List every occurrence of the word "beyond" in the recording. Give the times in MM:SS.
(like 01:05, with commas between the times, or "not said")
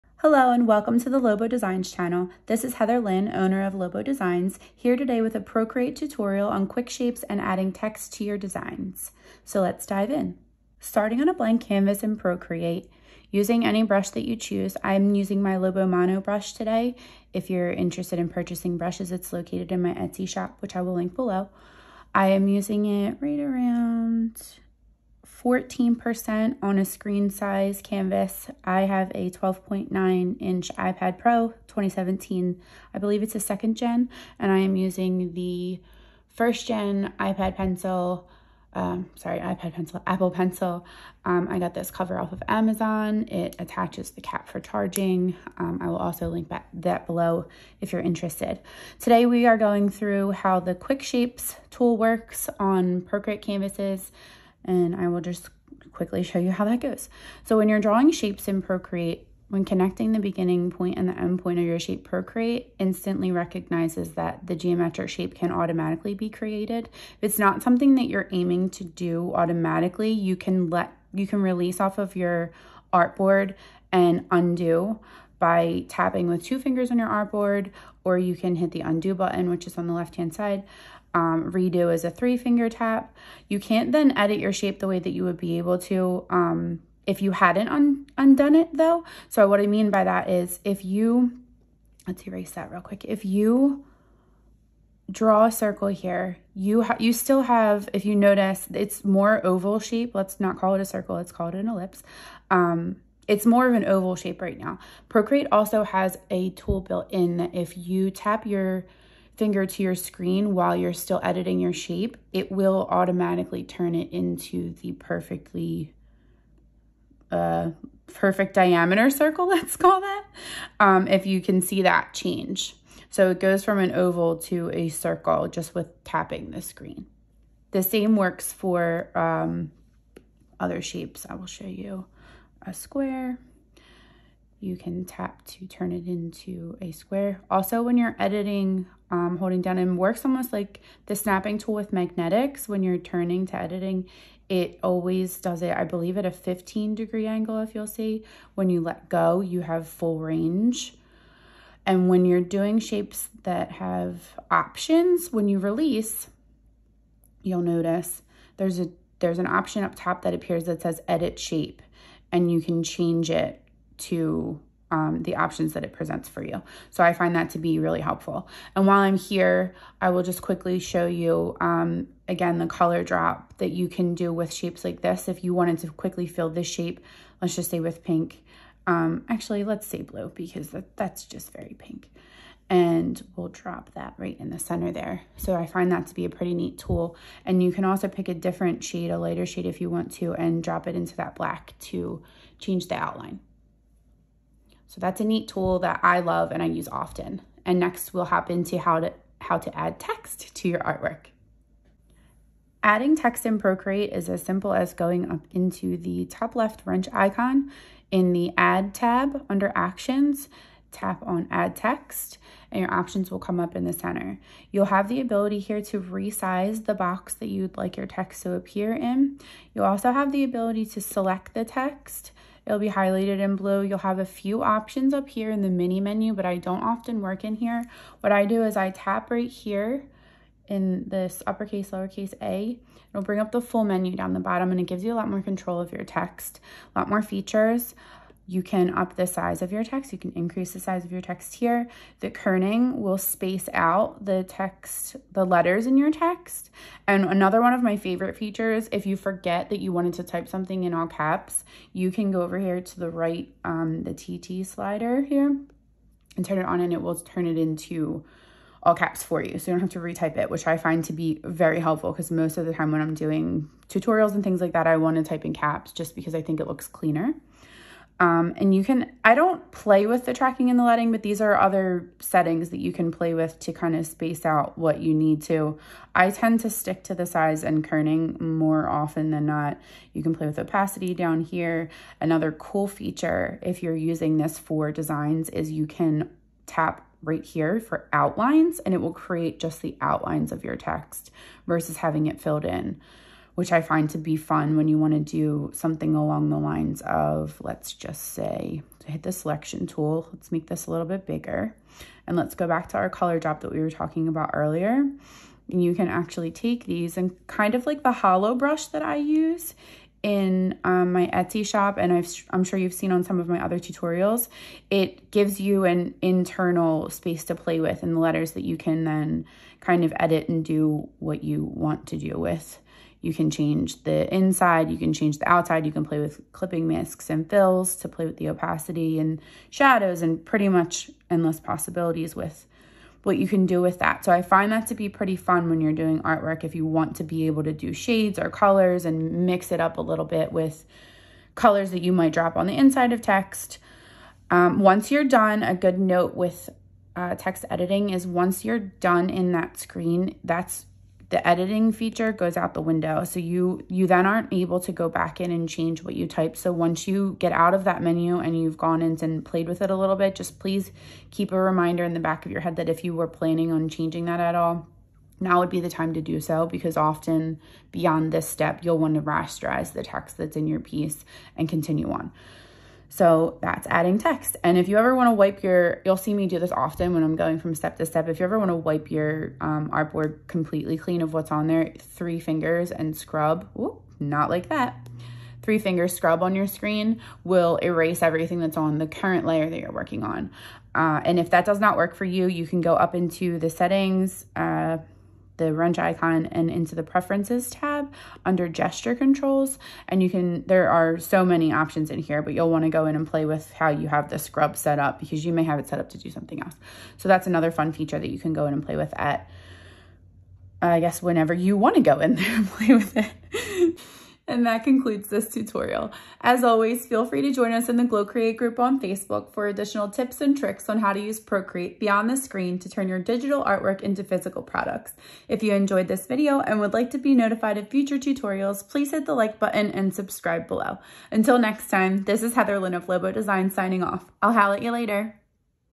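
06:07, 07:02.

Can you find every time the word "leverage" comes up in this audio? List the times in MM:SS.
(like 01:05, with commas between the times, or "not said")
not said.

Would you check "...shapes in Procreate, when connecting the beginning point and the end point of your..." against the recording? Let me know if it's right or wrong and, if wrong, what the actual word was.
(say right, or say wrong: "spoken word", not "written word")
right.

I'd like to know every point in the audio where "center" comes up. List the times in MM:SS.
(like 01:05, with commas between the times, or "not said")
03:04, 03:33.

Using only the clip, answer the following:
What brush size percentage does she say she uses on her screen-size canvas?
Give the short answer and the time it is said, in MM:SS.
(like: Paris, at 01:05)
14%, at 00:25.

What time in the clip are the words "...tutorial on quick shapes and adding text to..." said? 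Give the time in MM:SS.
00:05.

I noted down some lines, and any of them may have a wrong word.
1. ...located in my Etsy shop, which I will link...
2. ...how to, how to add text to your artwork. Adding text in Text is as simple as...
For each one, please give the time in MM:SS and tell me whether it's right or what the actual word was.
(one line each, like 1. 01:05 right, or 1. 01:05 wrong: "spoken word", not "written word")
1. 00:19 right
2. 03:18 wrong: "Procreate", not "Text".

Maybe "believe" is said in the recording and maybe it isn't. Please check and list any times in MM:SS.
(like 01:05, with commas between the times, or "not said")
00:32, 02:25.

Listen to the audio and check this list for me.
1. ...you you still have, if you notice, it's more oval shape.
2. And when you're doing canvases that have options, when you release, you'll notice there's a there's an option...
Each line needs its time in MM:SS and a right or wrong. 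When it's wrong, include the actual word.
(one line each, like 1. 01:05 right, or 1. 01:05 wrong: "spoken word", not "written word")
1. 01:36 right
2. 02:31 wrong: "shapes", not "canvases".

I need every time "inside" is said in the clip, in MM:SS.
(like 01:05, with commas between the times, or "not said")
05:24, 05:42.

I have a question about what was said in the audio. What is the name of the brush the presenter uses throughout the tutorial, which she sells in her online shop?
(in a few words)
Lobo Mono.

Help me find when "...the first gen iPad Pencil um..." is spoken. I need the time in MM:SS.
00:35.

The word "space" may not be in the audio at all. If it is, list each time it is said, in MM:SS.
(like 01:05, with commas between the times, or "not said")
04:03, 04:34, 05:17.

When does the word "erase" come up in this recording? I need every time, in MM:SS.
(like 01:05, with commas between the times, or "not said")
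01:32, 06:27.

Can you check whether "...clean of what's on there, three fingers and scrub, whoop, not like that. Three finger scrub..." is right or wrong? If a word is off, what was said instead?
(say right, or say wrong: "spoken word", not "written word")
right.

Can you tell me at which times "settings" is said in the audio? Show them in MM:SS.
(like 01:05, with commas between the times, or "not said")
04:32, 06:33.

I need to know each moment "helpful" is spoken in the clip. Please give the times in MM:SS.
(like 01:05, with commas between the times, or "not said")
02:48, 04:21.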